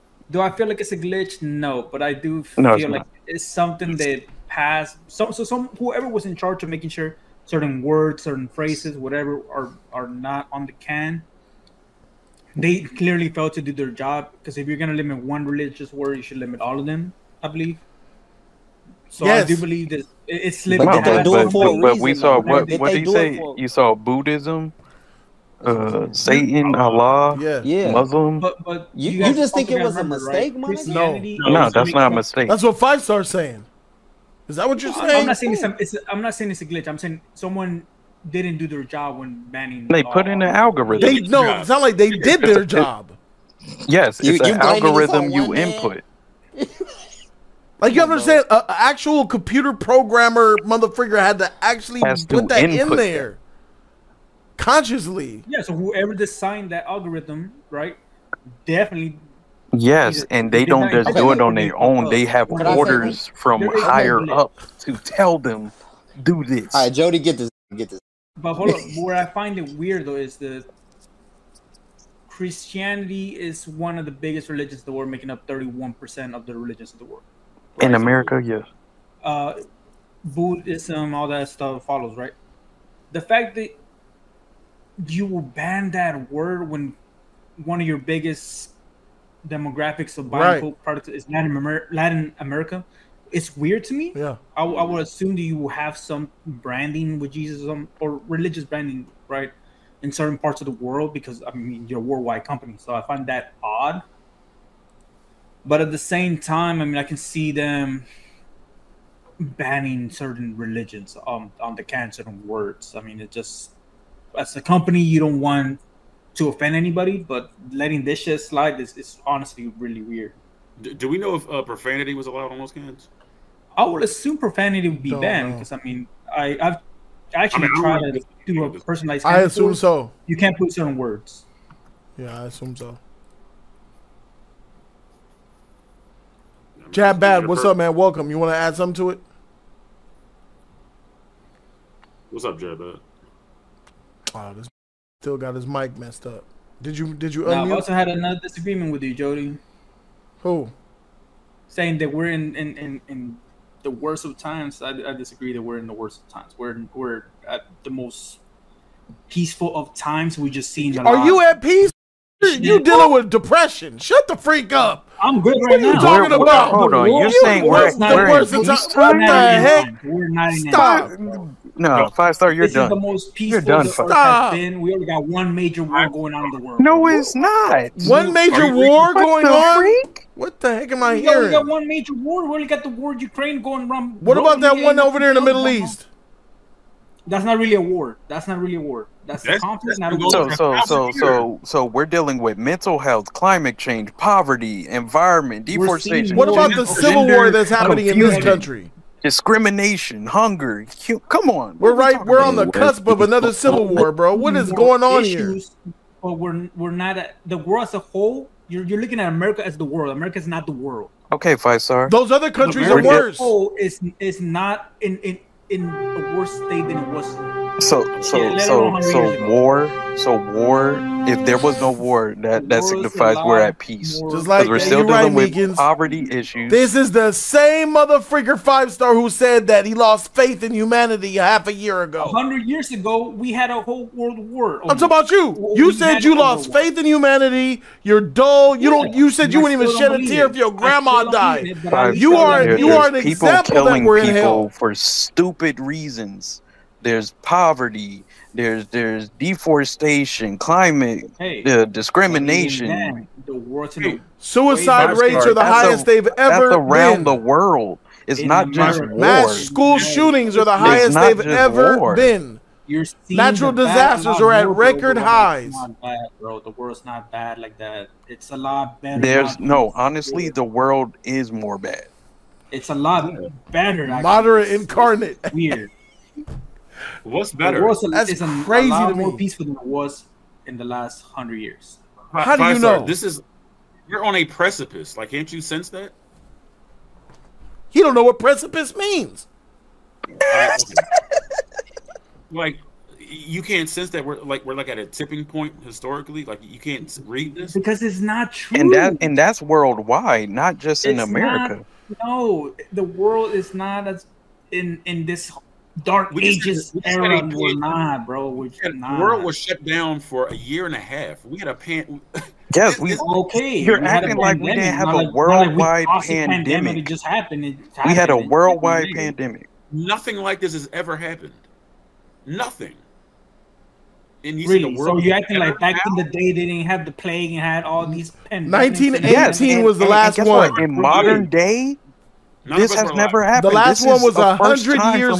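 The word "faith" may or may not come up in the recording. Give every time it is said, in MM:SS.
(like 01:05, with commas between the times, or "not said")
03:50, 03:56.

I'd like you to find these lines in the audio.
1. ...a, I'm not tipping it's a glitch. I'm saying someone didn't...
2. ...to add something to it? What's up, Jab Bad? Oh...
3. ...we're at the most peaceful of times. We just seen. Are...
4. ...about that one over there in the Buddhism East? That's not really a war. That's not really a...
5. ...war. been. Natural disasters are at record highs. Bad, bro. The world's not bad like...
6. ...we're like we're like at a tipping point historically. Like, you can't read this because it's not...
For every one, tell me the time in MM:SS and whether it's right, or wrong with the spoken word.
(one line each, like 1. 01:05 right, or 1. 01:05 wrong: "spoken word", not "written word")
1. 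00:35 wrong: "saying", not "tipping"
2. 02:18 right
3. 02:36 right
4. 03:04 wrong: "Middle", not "Buddhism"
5. 04:21 right
6. 04:54 right.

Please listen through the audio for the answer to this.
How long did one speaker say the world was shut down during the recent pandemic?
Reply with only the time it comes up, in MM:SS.
05:10.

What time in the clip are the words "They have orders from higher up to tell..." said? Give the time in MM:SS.
01:02.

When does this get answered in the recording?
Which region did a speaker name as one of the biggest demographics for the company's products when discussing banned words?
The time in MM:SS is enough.
01:31.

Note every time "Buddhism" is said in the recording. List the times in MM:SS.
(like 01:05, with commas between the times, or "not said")
00:23, 01:20.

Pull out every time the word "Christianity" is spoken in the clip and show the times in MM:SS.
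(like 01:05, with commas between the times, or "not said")
00:30, 01:12.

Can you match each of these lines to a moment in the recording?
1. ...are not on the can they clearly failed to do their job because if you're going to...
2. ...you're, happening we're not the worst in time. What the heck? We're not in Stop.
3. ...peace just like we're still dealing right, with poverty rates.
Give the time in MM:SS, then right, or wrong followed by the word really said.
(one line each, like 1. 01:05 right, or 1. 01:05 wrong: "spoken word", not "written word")
1. 00:09 right
2. 02:47 wrong: "saying", not "happening"
3. 03:43 wrong: "issues", not "rates".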